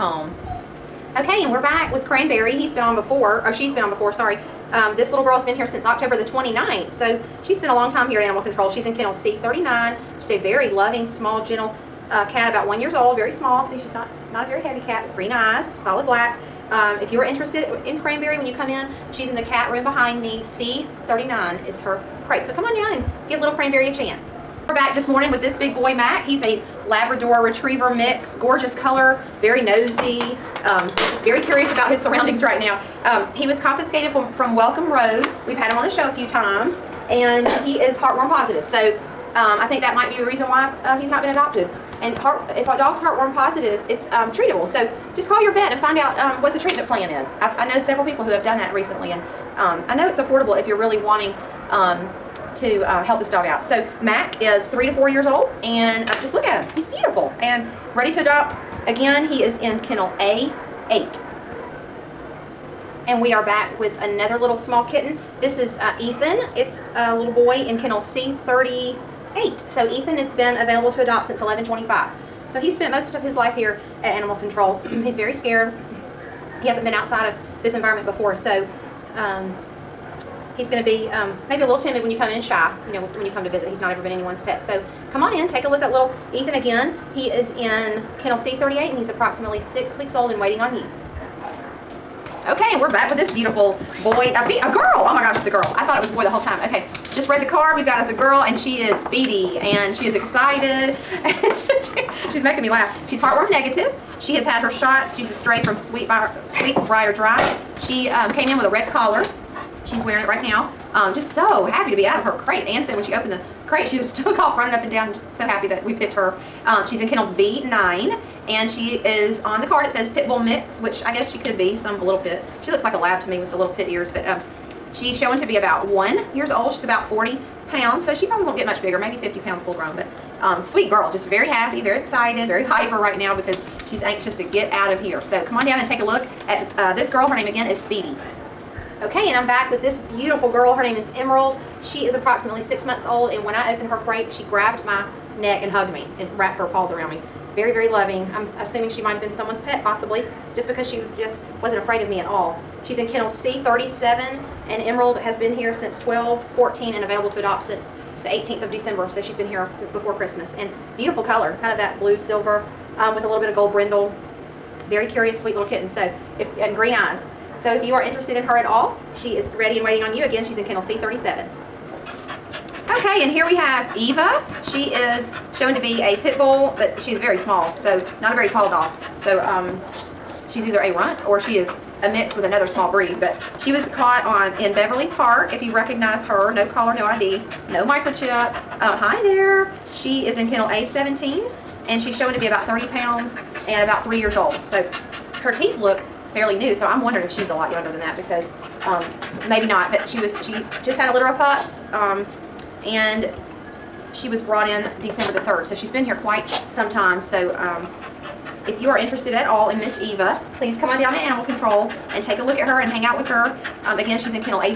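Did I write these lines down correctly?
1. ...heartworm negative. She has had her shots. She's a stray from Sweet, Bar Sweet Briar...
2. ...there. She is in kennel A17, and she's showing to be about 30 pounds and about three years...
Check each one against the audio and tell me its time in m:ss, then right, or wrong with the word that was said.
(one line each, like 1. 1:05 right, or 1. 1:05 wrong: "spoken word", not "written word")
1. 1:43 right
2. 3:09 right.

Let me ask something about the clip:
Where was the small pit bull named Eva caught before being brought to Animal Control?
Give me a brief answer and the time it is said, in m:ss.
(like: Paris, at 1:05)
Beverly Park, at 3:04.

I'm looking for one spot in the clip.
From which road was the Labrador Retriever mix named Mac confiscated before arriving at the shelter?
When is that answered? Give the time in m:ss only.
0:34.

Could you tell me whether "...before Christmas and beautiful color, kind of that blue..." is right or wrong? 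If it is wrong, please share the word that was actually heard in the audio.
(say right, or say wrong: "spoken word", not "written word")
right.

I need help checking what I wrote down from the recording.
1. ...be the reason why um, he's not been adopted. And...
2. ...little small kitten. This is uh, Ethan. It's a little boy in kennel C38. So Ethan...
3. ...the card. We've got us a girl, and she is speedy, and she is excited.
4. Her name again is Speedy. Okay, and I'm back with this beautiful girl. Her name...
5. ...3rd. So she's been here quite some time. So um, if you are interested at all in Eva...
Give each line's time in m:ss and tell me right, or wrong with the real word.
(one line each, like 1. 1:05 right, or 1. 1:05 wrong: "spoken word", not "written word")
1. 0:40 right
2. 1:04 right
3. 1:37 right
4. 2:17 right
5. 3:25 wrong: "Miss", not "Eva".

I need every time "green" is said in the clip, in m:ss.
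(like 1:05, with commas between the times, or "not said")
0:15, 2:46.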